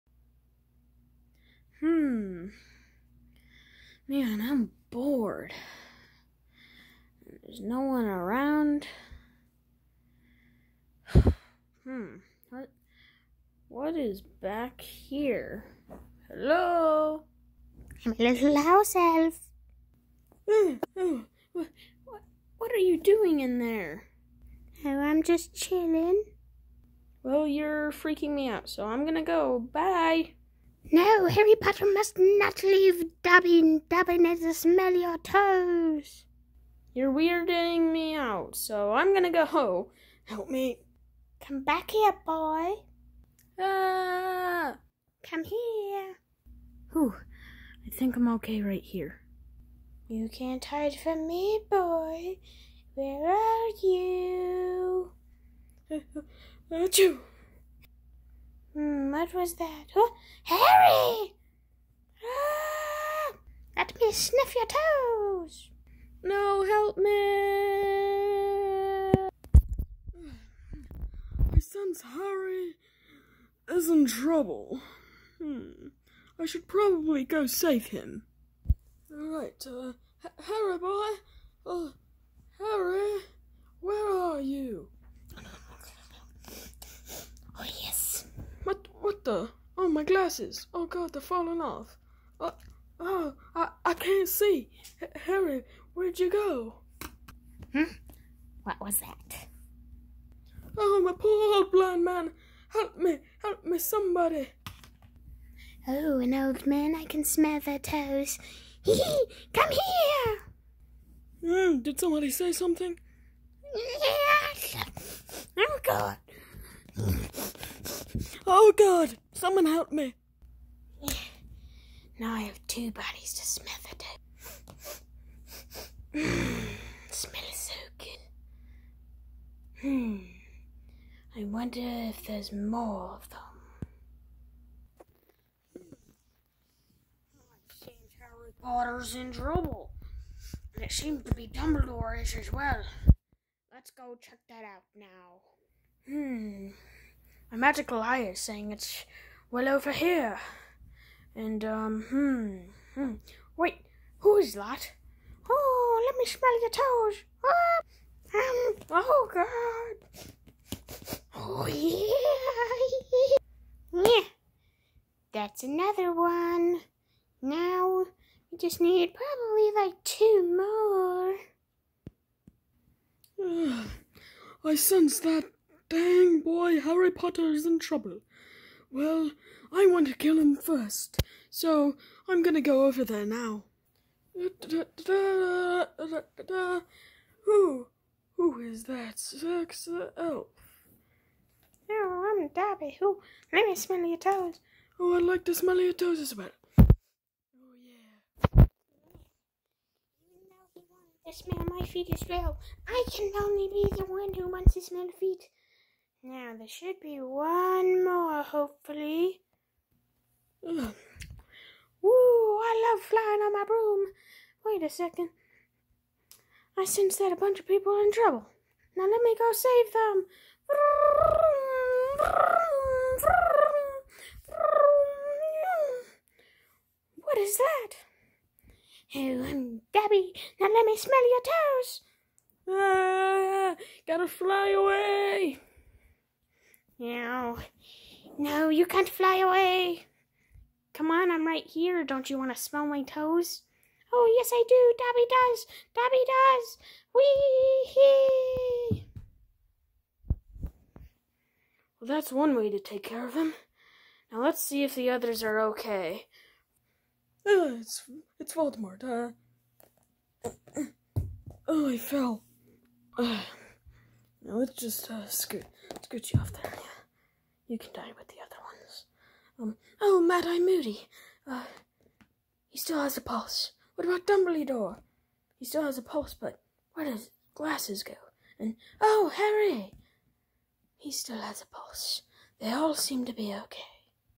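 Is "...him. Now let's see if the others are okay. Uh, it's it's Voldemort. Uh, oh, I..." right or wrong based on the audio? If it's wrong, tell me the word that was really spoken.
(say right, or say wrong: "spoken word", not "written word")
right.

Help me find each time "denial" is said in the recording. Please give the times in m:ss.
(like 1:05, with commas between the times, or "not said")
not said.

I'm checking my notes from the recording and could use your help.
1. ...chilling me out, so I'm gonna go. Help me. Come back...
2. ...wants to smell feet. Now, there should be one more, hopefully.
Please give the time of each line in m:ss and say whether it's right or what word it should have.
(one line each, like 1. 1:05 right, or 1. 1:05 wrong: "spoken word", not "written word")
1. 0:37 wrong: "weirding", not "chilling"
2. 3:24 right.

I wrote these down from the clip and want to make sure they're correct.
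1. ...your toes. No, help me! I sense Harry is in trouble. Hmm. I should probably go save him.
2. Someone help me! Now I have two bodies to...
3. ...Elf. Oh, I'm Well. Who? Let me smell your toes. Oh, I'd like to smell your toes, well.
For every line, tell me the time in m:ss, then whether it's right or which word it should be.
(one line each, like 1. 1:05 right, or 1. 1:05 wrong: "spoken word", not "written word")
1. 1:04 right
2. 1:59 right
3. 3:10 wrong: "Dobby", not "Well".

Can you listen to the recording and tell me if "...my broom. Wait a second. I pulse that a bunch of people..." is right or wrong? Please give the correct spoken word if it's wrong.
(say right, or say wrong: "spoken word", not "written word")
wrong: "sense", not "pulse".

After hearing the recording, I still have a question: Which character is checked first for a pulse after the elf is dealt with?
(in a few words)
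Mad Eye Moody.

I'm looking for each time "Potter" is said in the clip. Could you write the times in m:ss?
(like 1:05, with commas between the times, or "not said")
0:31, 2:18, 2:57.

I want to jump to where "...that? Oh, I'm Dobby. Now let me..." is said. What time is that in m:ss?
3:47.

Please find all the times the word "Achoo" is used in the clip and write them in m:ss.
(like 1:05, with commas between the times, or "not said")
0:56.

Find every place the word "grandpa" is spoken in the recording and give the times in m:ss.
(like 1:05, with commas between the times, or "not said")
not said.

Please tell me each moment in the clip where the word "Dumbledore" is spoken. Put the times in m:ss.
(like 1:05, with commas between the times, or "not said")
2:21, 4:34.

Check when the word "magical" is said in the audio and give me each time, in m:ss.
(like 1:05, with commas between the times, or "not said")
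2:27.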